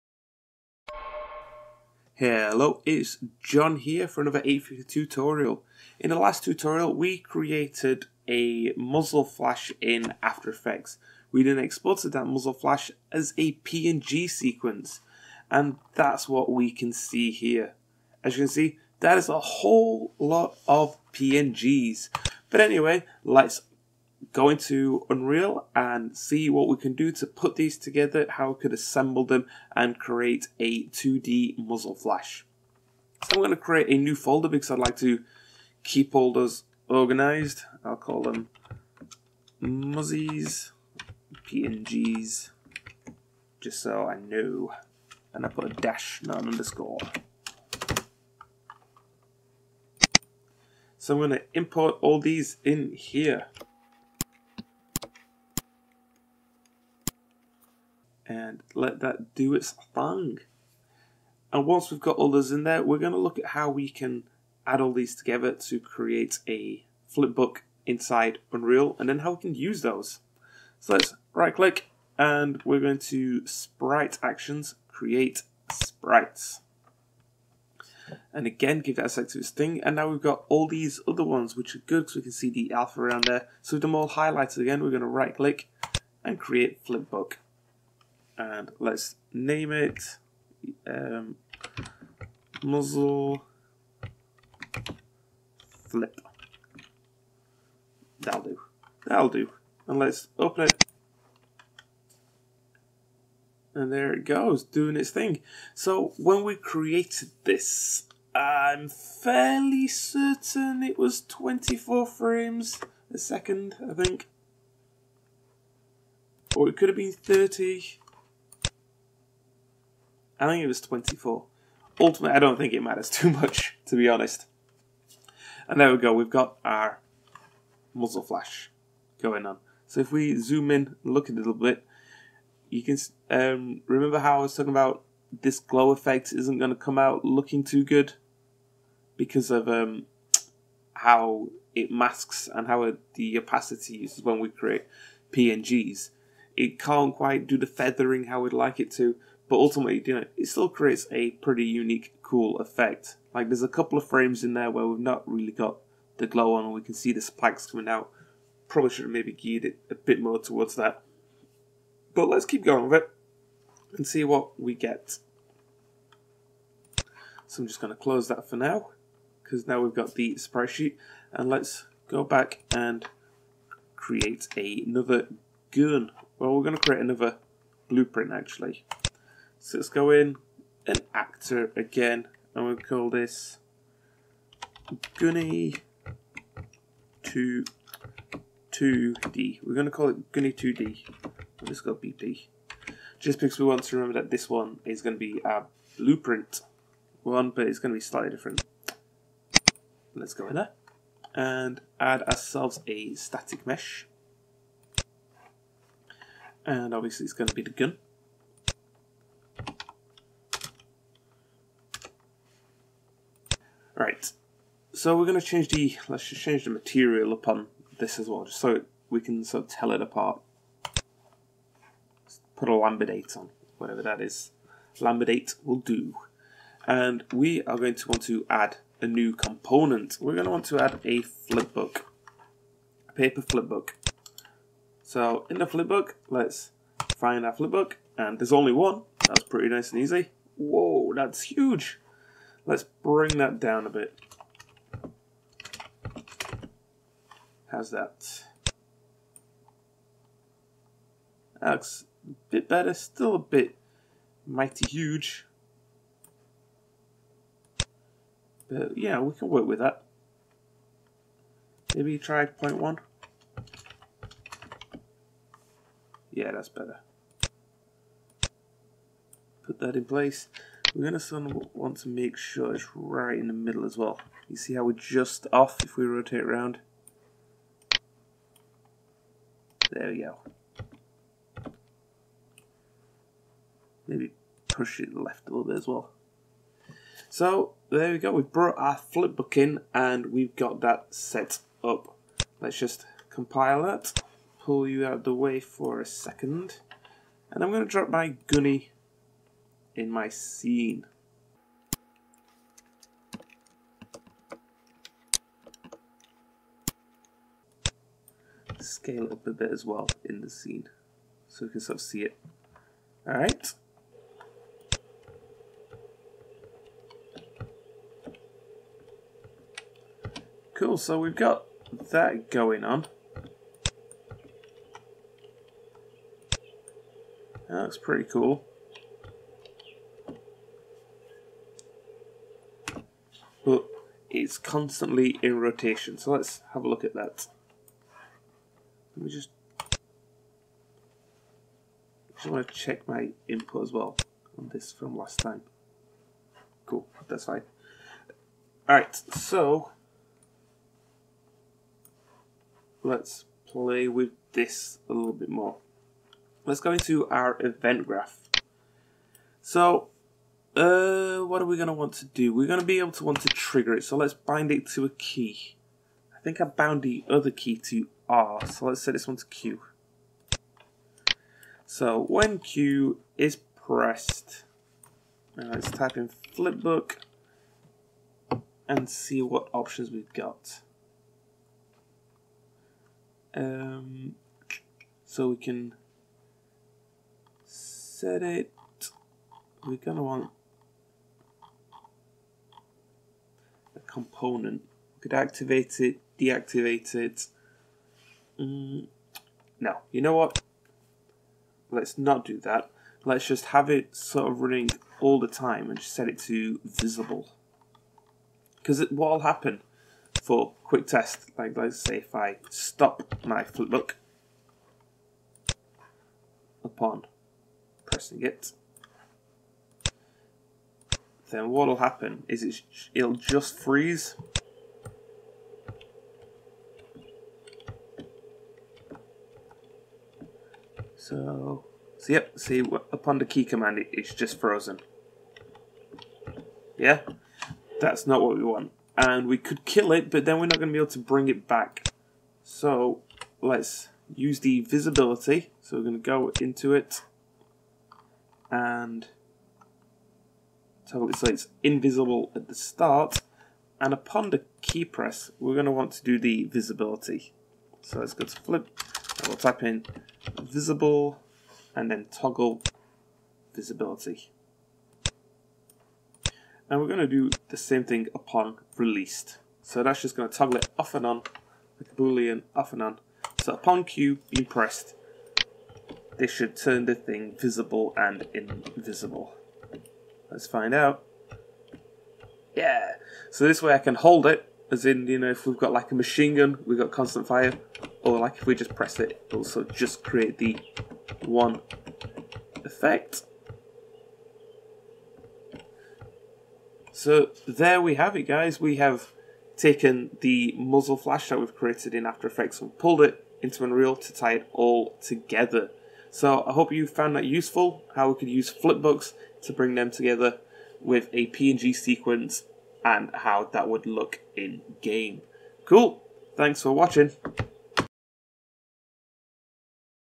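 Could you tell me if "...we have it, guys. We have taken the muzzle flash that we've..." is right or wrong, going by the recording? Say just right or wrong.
right.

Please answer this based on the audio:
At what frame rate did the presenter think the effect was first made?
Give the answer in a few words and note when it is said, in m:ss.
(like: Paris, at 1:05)
24 frames a second, at 1:51.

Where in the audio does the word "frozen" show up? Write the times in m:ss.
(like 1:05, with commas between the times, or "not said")
7:14.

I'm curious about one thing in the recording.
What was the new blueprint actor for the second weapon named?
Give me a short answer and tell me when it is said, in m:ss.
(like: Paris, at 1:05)
Gunny 2D, at 3:10.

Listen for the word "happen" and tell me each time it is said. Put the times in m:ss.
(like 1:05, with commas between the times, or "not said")
6:49, 7:01.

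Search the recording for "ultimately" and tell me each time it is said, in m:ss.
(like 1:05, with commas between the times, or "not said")
2:01, 2:29.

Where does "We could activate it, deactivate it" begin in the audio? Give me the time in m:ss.
6:35.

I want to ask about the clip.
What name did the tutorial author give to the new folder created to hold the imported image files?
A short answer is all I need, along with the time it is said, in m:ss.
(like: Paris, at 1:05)
muzzies PNGs, at 0:39.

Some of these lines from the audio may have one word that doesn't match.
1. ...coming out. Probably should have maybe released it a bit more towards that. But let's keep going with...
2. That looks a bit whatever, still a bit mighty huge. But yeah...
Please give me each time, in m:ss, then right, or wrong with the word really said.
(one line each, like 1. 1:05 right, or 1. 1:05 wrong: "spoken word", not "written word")
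1. 2:37 wrong: "geared", not "released"
2. 4:11 wrong: "better", not "whatever".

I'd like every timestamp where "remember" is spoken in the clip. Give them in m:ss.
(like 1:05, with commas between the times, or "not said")
2:13, 3:13.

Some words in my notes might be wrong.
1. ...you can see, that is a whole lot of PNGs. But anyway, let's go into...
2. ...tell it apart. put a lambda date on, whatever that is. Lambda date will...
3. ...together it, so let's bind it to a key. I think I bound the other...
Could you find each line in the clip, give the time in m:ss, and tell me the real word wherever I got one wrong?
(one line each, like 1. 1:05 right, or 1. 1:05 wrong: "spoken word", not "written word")
1. 0:18 right
2. 3:39 right
3. 6:03 wrong: "trigger", not "together".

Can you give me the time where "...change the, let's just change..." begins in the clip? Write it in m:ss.
3:35.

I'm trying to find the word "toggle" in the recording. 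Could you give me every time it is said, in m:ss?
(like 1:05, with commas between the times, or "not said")
7:42, 7:50.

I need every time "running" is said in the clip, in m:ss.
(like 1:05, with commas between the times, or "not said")
6:44.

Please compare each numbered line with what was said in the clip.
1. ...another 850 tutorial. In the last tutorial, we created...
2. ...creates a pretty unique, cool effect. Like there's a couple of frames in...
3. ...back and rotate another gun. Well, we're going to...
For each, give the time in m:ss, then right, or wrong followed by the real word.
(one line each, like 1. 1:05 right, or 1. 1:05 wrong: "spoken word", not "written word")
1. 0:04 right
2. 2:30 right
3. 2:52 wrong: "create", not "rotate".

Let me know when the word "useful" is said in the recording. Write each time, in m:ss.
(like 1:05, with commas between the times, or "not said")
8:27.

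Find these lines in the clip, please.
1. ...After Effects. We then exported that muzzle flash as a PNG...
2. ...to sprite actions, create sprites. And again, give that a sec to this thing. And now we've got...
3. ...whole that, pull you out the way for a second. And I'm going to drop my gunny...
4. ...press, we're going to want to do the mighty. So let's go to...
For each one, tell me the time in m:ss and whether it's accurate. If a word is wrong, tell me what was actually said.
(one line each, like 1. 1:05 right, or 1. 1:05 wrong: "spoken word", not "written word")
1. 0:10 right
2. 1:12 right
3. 4:53 wrong: "compile", not "whole"
4. 7:35 wrong: "visibility", not "mighty".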